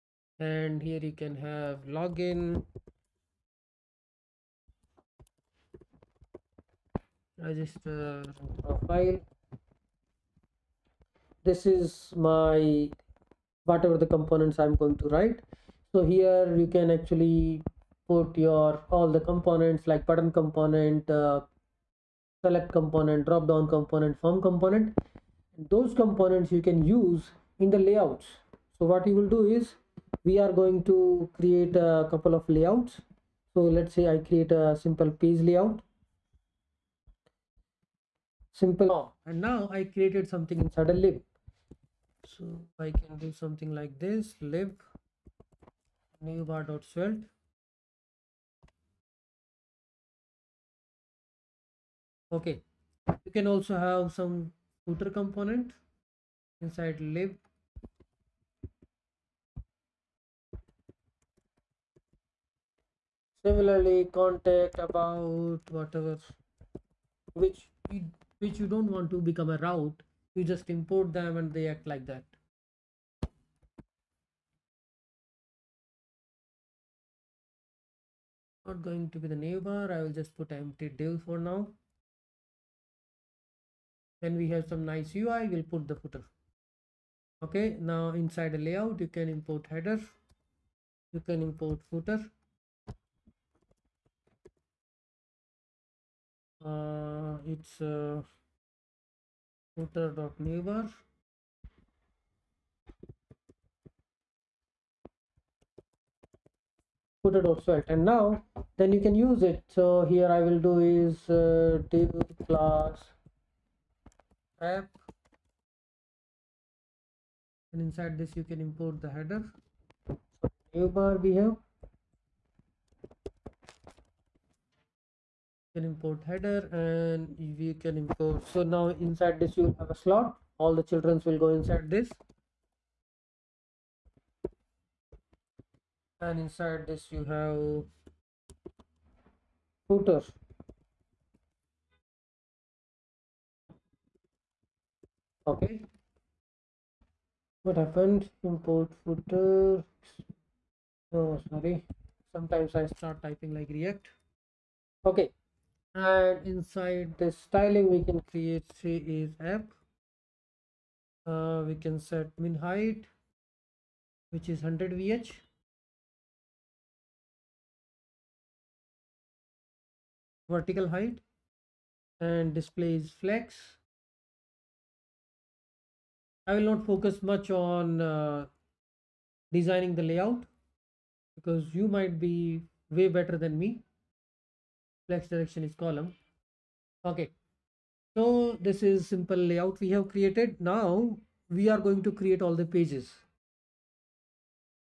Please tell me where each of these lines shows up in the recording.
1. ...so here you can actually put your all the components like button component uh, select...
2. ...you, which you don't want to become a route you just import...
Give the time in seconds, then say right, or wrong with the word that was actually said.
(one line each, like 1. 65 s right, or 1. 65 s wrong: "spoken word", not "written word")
1. 15 s right
2. 67 s right.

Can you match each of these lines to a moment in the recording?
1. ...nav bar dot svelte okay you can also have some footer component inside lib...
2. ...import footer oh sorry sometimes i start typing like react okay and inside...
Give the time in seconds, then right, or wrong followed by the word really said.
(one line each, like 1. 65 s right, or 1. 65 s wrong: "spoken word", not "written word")
1. 46 s right
2. 148 s right.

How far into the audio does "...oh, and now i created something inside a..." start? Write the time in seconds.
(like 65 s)
38 s.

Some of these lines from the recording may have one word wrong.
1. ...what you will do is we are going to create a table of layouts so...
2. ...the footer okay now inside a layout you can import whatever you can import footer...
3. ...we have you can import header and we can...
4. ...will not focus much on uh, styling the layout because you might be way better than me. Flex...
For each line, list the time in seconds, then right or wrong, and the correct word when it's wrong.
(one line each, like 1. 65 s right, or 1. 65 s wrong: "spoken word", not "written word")
1. 28 s wrong: "couple", not "table"
2. 85 s wrong: "header", not "whatever"
3. 121 s right
4. 176 s wrong: "designing", not "styling".